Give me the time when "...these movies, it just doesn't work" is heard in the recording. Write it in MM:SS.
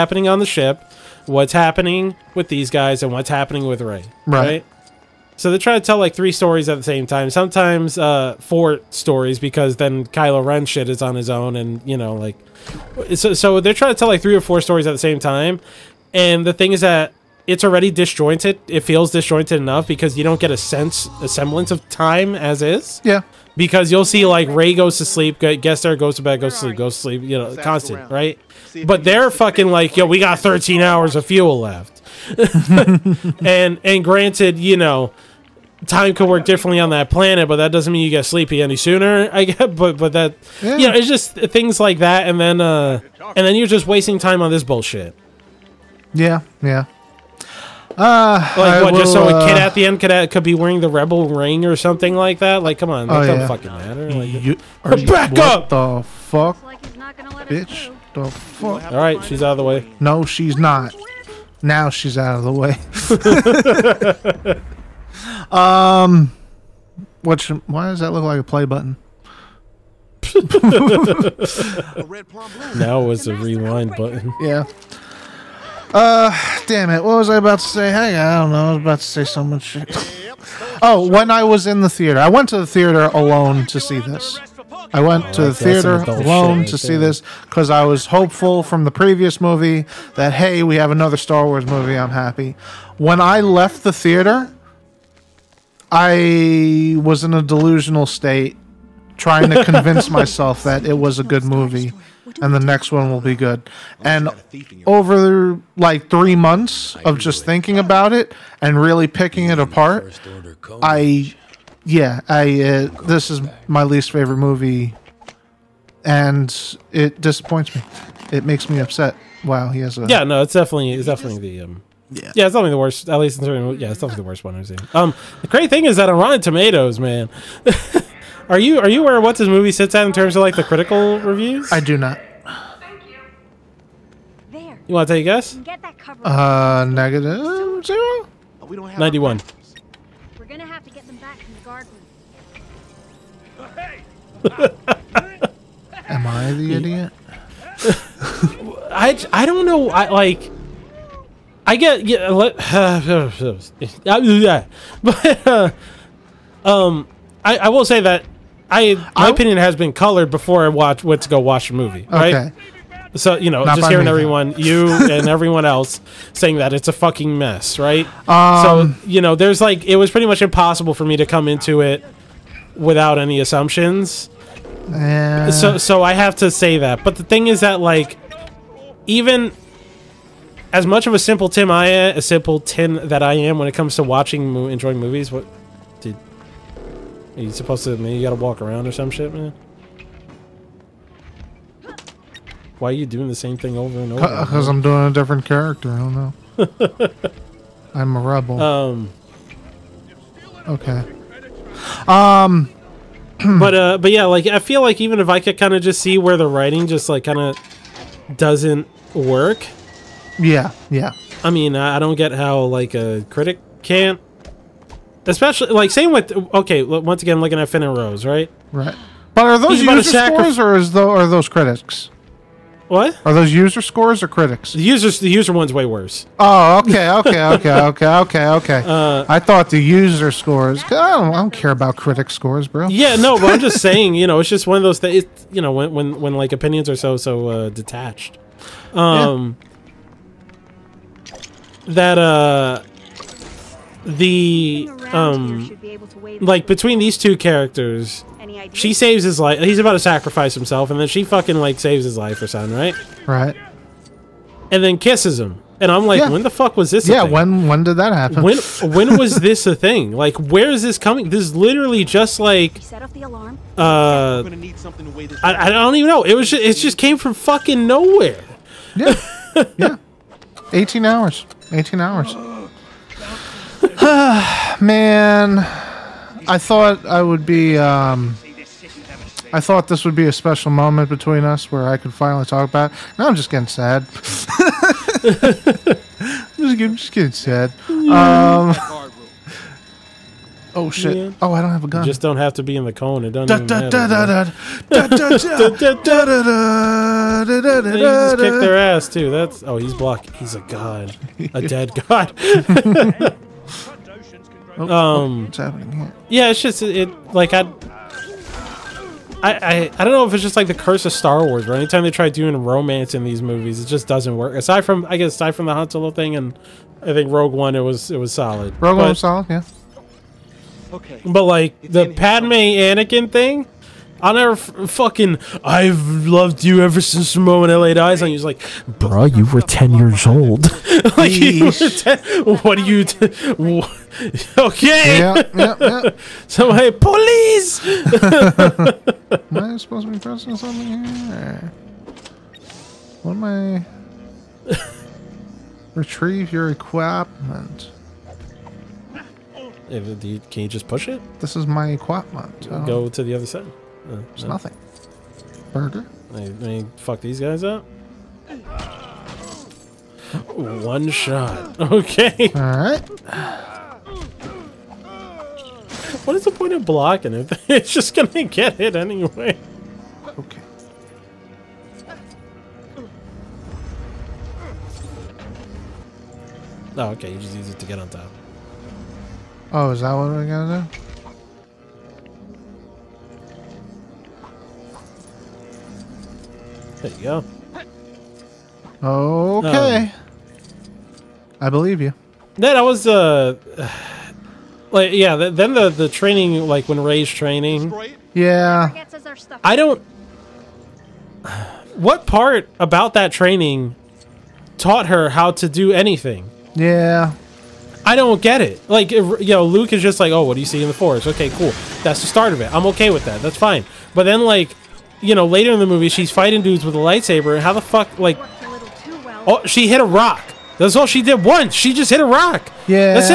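05:13.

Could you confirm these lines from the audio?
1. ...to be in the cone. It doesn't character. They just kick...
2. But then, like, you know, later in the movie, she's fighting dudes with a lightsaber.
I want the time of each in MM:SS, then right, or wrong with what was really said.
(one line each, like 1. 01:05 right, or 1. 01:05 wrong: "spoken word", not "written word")
1. 04:52 wrong: "matter", not "character"
2. 06:54 right.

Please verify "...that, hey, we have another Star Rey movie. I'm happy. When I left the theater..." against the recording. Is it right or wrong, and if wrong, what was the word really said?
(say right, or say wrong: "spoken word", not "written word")
wrong: "Wars", not "Rey".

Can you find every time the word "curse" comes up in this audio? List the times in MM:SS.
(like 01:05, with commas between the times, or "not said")
05:10.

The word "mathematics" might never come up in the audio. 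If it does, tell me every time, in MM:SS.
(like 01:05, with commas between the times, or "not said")
not said.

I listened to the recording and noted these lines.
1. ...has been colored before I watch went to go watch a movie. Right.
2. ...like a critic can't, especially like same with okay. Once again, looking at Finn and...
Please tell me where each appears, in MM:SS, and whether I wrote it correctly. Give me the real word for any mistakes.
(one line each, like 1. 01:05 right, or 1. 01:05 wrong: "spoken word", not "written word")
1. 02:39 right
2. 03:32 right.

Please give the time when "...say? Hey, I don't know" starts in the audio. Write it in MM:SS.
01:17.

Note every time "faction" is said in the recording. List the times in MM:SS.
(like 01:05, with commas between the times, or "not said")
not said.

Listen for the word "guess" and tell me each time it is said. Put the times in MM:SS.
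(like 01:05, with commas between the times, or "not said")
02:15, 05:15.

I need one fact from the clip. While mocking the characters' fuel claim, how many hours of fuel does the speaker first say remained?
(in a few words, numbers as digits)
13.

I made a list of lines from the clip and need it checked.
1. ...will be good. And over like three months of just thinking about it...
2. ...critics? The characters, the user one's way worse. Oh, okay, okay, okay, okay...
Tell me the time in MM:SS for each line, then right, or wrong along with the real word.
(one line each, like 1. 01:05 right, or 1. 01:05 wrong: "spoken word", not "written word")
1. 01:43 right
2. 03:44 wrong: "users", not "characters".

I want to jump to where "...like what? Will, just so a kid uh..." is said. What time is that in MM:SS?
00:48.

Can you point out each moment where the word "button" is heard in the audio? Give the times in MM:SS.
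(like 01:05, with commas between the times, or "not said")
01:08, 01:13.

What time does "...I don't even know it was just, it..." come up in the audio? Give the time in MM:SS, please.
04:25.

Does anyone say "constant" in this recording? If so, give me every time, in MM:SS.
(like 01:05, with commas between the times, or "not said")
00:27.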